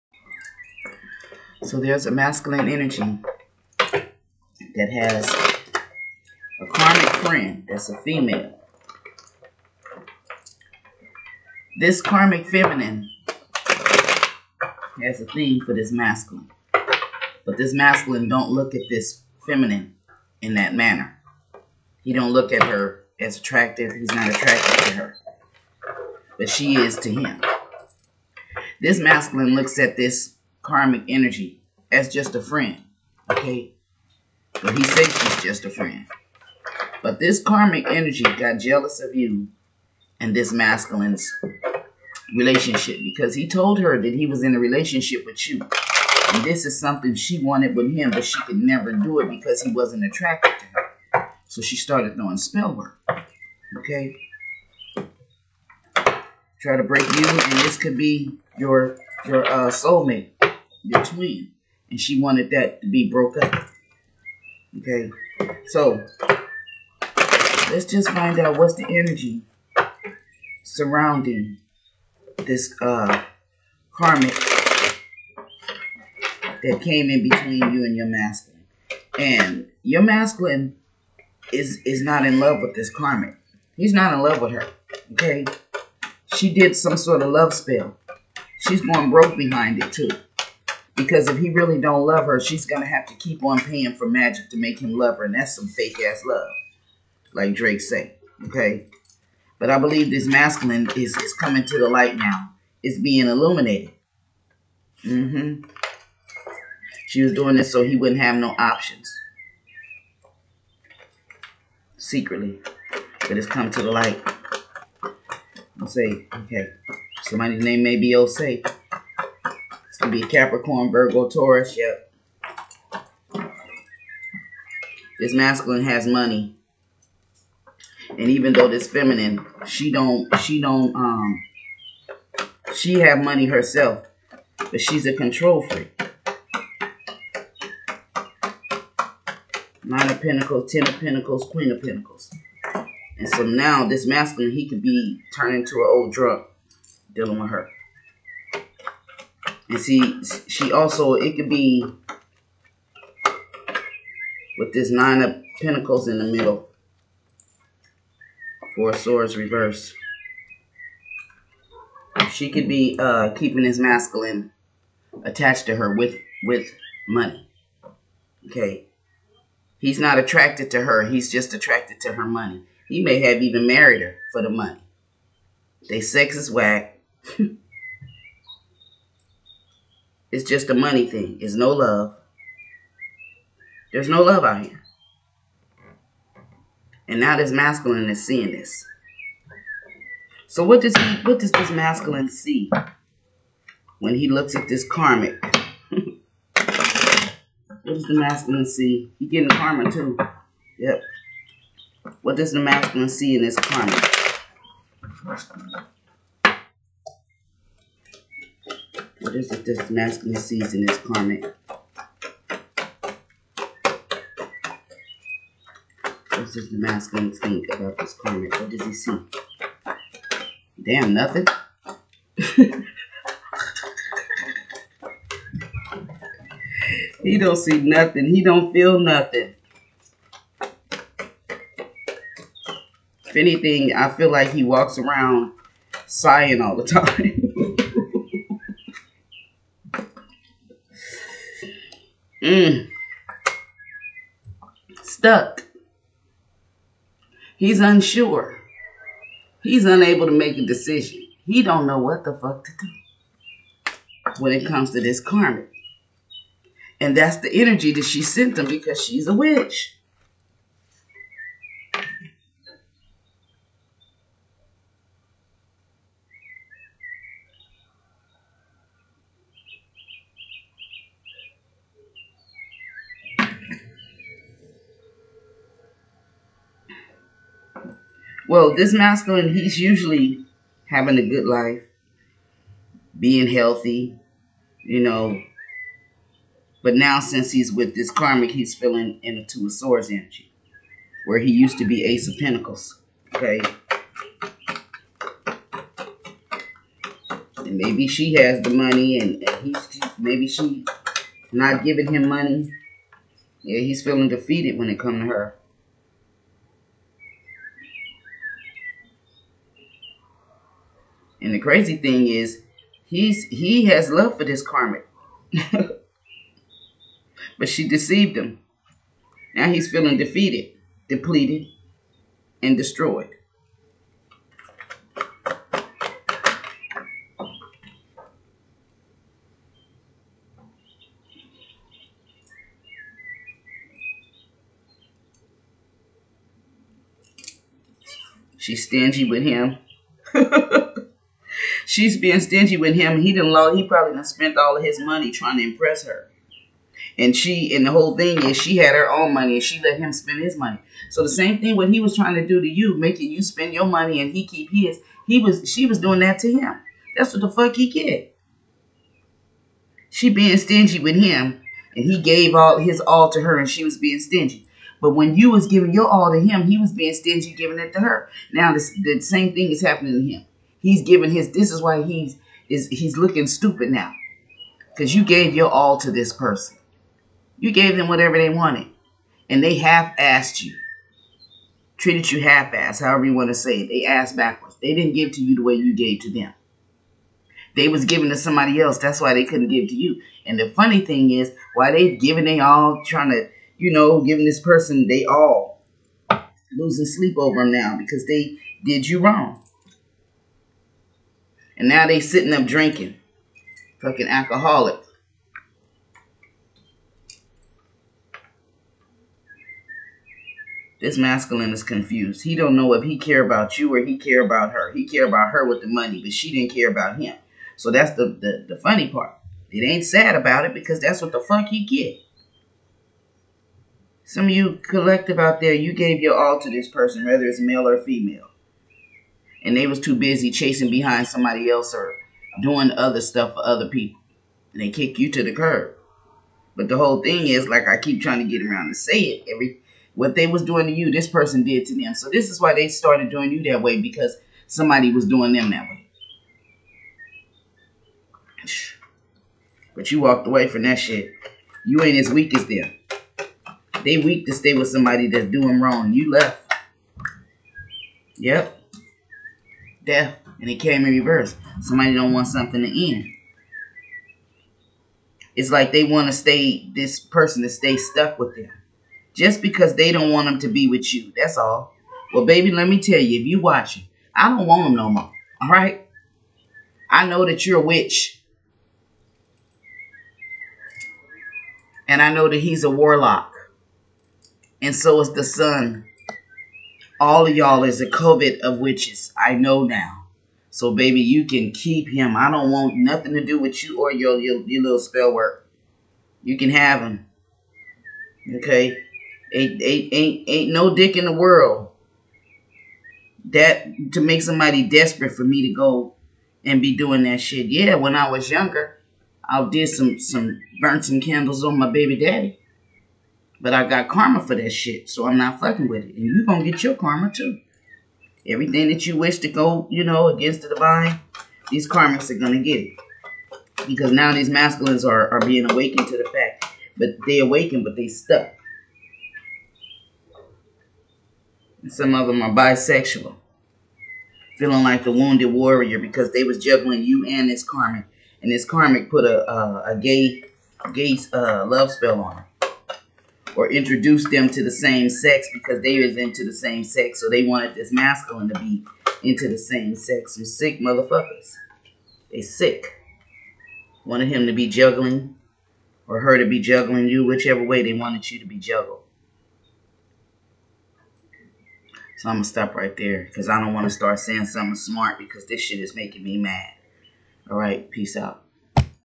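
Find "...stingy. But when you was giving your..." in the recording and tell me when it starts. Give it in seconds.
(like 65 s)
364 s.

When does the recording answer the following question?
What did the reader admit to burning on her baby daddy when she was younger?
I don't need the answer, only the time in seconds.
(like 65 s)
511 s.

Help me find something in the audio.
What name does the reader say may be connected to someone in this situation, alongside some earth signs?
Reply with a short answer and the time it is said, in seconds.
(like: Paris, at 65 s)
Osei, at 118 s.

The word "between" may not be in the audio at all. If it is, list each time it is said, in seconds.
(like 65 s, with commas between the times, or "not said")
60 s, 77 s.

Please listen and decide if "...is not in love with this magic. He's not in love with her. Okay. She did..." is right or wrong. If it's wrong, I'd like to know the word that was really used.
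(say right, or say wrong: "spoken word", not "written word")
wrong: "karmic", not "magic".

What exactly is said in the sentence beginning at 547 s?
So they wanted this masculine to be into the same sex.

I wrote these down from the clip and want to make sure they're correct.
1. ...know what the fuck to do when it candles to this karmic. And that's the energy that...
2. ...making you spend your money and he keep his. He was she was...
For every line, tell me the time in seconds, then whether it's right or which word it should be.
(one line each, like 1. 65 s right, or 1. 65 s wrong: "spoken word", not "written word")
1. 251 s wrong: "comes", not "candles"
2. 352 s right.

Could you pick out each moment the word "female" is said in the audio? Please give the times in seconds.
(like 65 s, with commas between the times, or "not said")
7 s, 428 s.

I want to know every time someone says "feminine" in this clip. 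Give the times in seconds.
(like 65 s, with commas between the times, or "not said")
12 s, 19 s, 128 s.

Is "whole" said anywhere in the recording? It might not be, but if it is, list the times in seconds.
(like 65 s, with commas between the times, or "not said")
347 s, 436 s.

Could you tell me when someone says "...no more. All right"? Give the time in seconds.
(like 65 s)
474 s.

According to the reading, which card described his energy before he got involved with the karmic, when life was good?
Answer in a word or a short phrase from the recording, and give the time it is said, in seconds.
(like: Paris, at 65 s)
Ace of Pentacles, at 292 s.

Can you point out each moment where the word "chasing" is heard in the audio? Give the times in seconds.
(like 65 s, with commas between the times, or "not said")
430 s.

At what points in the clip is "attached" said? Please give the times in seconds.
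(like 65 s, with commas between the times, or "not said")
165 s.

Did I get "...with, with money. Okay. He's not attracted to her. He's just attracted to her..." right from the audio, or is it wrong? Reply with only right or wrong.
right.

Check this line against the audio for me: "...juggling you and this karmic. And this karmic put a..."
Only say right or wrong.
right.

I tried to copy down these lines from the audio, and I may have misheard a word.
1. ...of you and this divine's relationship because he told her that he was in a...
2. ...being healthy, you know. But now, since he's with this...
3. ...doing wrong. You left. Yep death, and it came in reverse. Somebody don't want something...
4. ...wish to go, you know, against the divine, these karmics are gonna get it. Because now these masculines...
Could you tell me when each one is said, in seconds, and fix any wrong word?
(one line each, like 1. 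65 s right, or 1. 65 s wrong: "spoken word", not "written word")
1. 39 s wrong: "masculine", not "divine"
2. 283 s right
3. 455 s right
4. 519 s right.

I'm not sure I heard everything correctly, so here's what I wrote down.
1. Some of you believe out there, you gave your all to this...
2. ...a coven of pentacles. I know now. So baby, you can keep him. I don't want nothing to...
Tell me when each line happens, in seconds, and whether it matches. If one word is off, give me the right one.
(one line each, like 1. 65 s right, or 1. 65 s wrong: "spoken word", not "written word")
1. 424 s wrong: "collective", not "believe"
2. 488 s wrong: "witches", not "pentacles".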